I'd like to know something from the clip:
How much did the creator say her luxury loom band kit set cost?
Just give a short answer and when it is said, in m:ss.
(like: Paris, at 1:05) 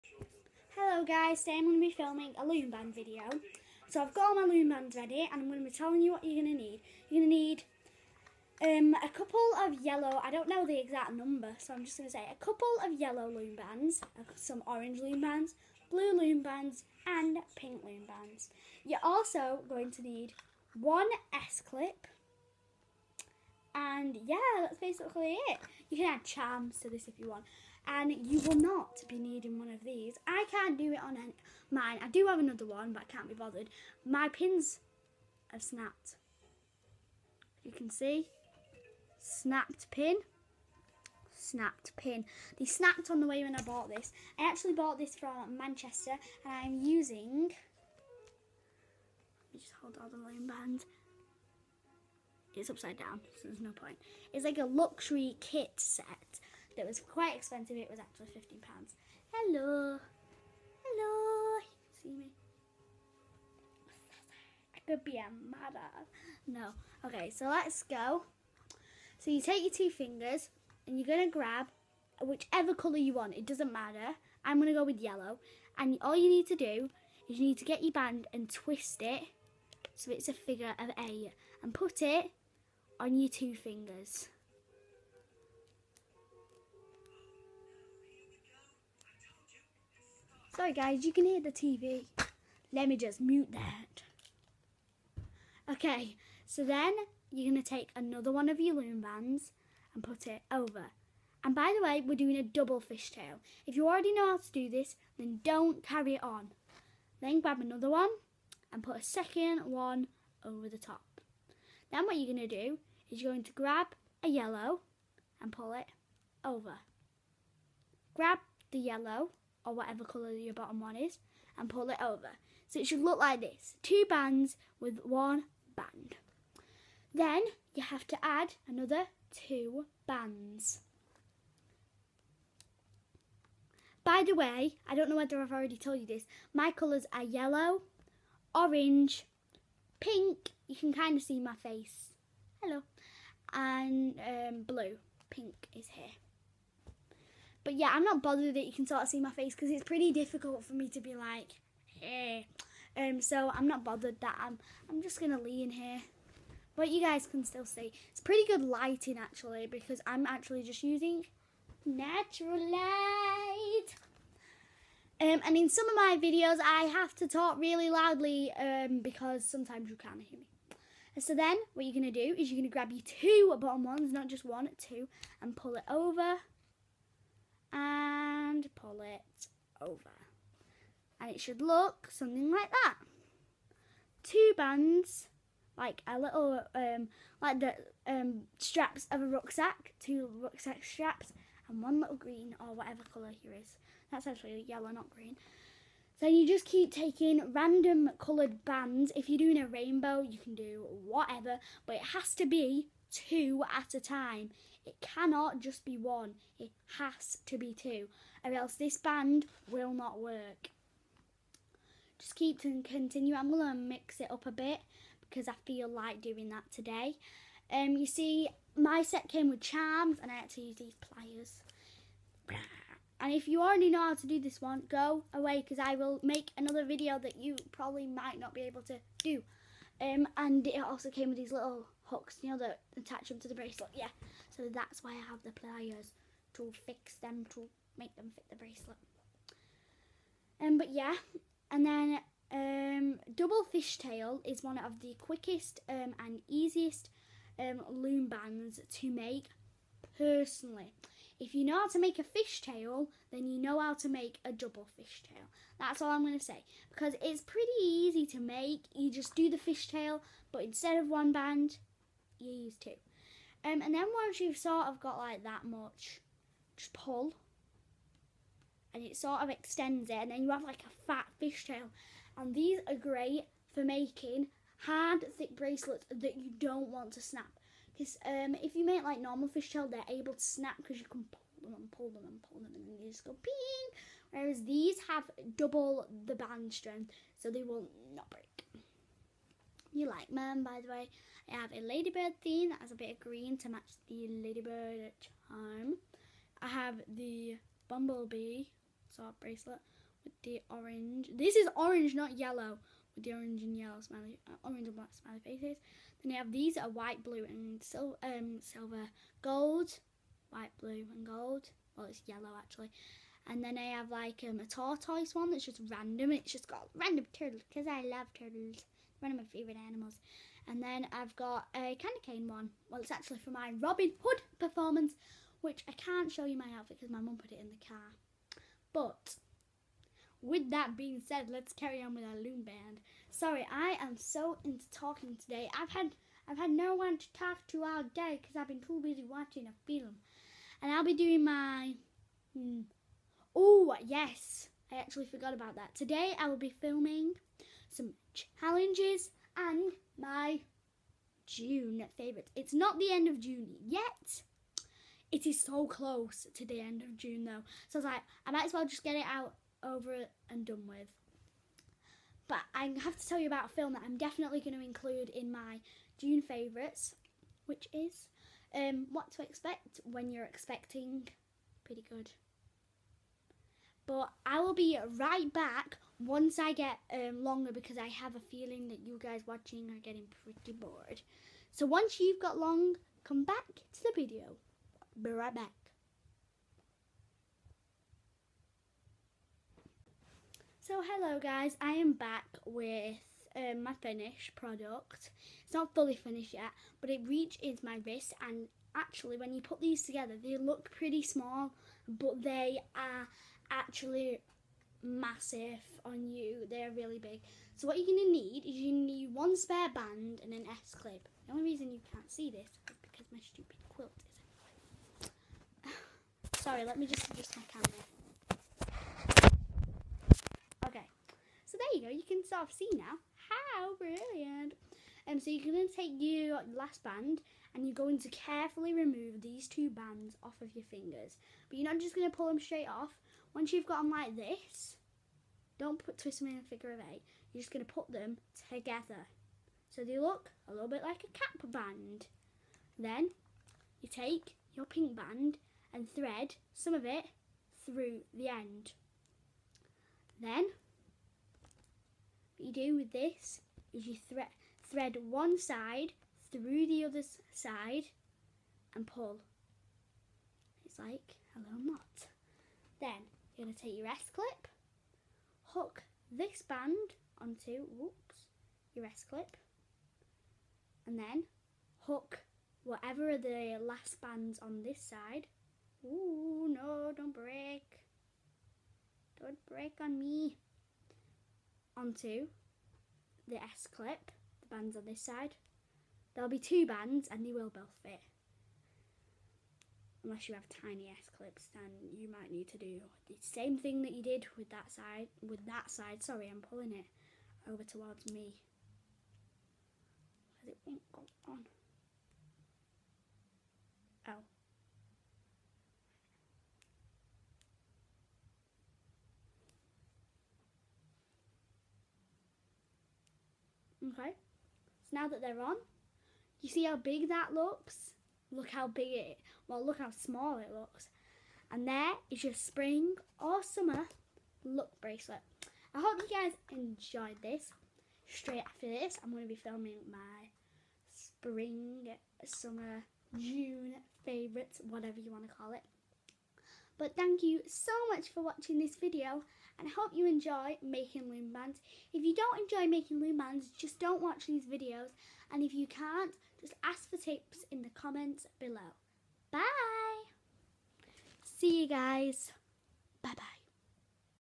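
£15, at 0:58.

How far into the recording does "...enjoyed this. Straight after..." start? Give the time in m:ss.
8:46.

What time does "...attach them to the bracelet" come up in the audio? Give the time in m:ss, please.
3:52.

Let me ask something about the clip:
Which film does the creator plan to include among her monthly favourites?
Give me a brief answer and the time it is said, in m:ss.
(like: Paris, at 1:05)
What to Expect When You're Expecting, at 6:09.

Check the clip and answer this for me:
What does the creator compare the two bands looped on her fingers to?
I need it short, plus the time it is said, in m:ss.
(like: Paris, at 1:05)
Rucksack straps, at 3:10.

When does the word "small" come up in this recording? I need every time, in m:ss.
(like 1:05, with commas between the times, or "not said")
6:41, 8:40.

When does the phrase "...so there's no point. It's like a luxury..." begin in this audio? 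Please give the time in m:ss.
0:53.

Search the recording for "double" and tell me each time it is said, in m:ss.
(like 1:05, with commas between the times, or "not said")
1:42, 4:03, 4:14, 4:45.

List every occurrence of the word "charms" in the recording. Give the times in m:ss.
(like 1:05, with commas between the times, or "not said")
0:26, 3:39, 4:55.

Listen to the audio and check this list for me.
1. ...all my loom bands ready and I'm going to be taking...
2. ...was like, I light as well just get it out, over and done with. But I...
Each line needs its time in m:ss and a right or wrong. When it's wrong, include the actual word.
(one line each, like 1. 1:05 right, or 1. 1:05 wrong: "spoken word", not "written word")
1. 0:04 wrong: "telling", not "taking"
2. 5:57 wrong: "might", not "light".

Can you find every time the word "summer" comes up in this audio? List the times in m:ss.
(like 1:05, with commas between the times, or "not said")
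8:43, 8:52.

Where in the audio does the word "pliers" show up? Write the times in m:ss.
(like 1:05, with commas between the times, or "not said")
3:40, 3:55.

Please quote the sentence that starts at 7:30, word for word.
Then what you do with this is you thre thread one side through the other side and pull.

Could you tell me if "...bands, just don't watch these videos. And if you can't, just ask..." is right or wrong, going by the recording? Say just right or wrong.
right.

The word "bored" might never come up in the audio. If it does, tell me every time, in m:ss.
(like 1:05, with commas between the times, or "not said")
6:20.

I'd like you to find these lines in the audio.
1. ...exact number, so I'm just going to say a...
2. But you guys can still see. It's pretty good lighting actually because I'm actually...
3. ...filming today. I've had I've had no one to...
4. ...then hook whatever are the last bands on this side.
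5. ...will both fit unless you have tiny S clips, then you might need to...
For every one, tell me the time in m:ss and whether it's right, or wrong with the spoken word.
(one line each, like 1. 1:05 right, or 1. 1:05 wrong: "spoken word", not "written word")
1. 0:10 right
2. 2:36 right
3. 5:34 wrong: "talking", not "filming"
4. 7:51 right
5. 8:07 right.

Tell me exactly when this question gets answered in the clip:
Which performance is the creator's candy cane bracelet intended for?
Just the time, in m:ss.
5:23.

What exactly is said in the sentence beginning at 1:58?
Grab the yellow or whatever colour your bottom one is and pull it over.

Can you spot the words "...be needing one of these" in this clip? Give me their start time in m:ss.
0:29.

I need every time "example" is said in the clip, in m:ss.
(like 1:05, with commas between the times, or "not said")
not said.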